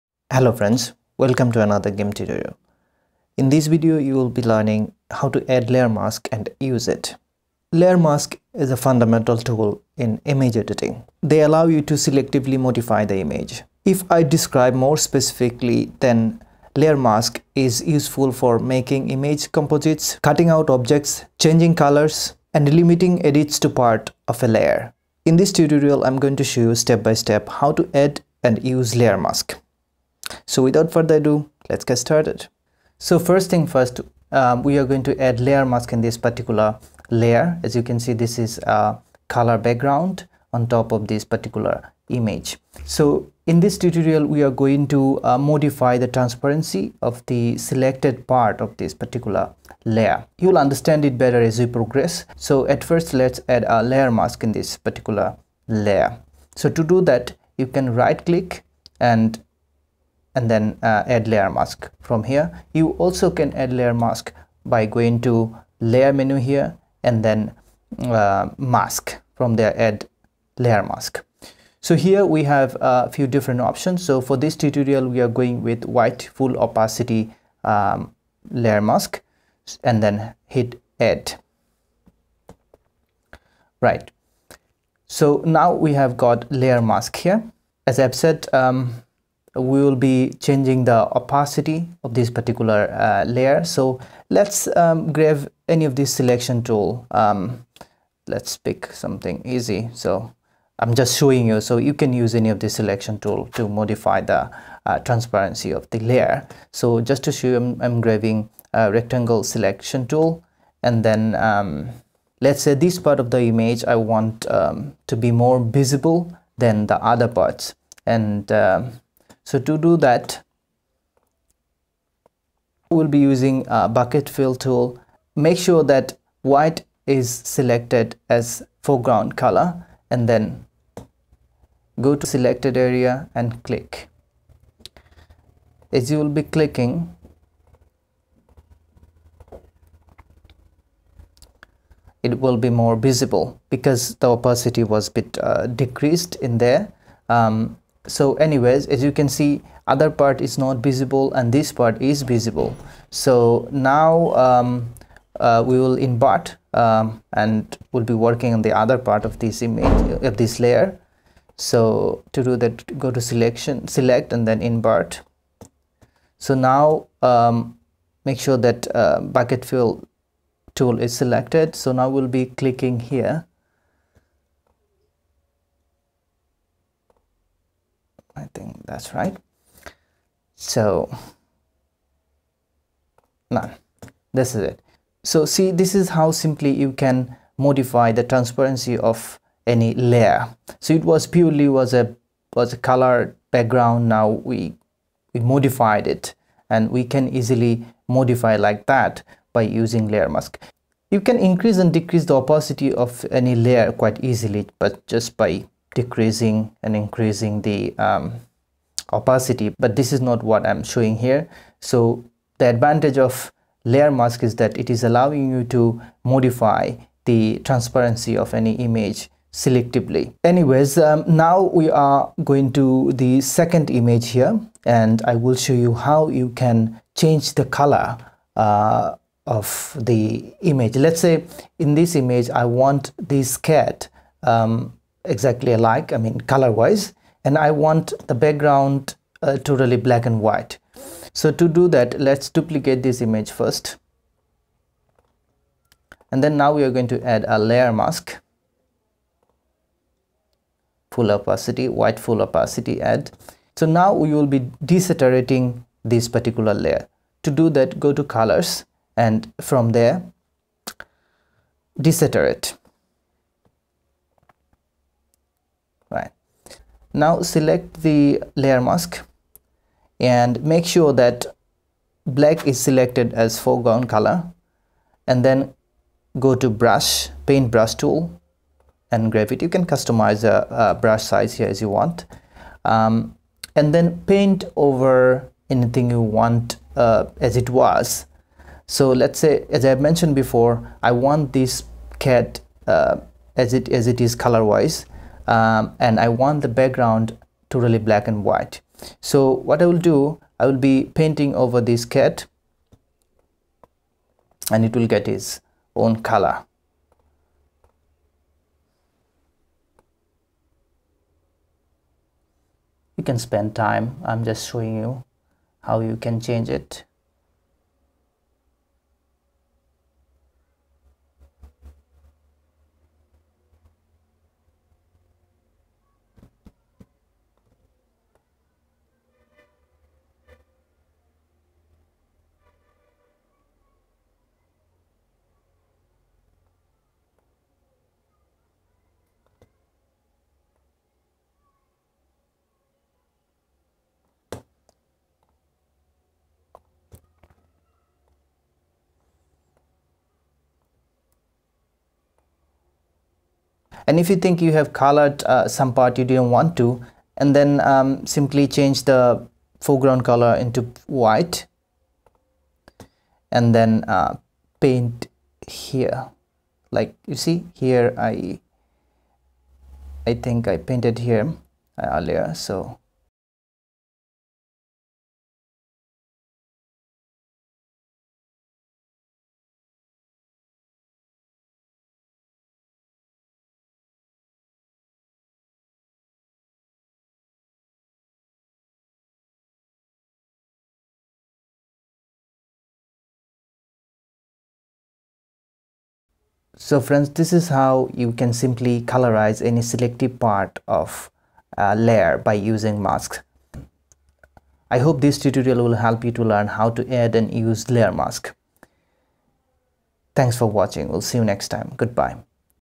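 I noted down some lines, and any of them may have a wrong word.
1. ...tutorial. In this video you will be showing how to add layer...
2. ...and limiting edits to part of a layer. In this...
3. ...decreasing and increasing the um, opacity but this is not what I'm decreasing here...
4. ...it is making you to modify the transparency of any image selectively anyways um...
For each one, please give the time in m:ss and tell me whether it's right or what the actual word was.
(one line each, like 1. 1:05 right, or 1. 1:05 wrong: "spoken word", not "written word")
1. 0:02 wrong: "learning", not "showing"
2. 0:22 right
3. 3:25 wrong: "showing", not "decreasing"
4. 3:34 wrong: "allowing", not "making".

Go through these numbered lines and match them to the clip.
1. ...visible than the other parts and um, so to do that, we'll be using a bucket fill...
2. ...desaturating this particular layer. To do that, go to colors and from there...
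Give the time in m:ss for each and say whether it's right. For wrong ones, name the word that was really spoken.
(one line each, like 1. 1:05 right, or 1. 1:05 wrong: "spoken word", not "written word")
1. 1:55 right
2. 4:14 right.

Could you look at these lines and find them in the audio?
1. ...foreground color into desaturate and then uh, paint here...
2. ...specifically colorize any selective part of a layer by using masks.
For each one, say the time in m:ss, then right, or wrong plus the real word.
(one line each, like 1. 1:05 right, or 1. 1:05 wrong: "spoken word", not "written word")
1. 5:59 wrong: "white", not "desaturate"
2. 6:38 wrong: "simply", not "specifically".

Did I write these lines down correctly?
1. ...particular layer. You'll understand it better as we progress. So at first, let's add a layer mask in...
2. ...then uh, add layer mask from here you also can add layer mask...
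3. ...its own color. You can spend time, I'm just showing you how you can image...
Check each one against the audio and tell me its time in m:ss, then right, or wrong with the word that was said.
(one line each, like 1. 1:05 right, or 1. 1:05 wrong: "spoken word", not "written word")
1. 0:48 right
2. 1:00 right
3. 5:05 wrong: "change", not "image".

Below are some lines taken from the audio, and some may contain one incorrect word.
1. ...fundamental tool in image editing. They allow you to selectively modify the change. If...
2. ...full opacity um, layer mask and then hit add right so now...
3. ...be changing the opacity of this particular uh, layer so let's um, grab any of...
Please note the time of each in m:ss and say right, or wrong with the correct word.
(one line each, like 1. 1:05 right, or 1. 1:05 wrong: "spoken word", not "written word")
1. 0:08 wrong: "image", not "change"
2. 1:16 right
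3. 1:29 right.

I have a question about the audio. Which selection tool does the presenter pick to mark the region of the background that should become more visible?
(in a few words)
Rectangle selection tool.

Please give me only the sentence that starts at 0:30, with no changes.
So without further ado, let's get started.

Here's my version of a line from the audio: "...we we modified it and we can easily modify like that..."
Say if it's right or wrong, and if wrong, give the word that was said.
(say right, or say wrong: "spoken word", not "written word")
right.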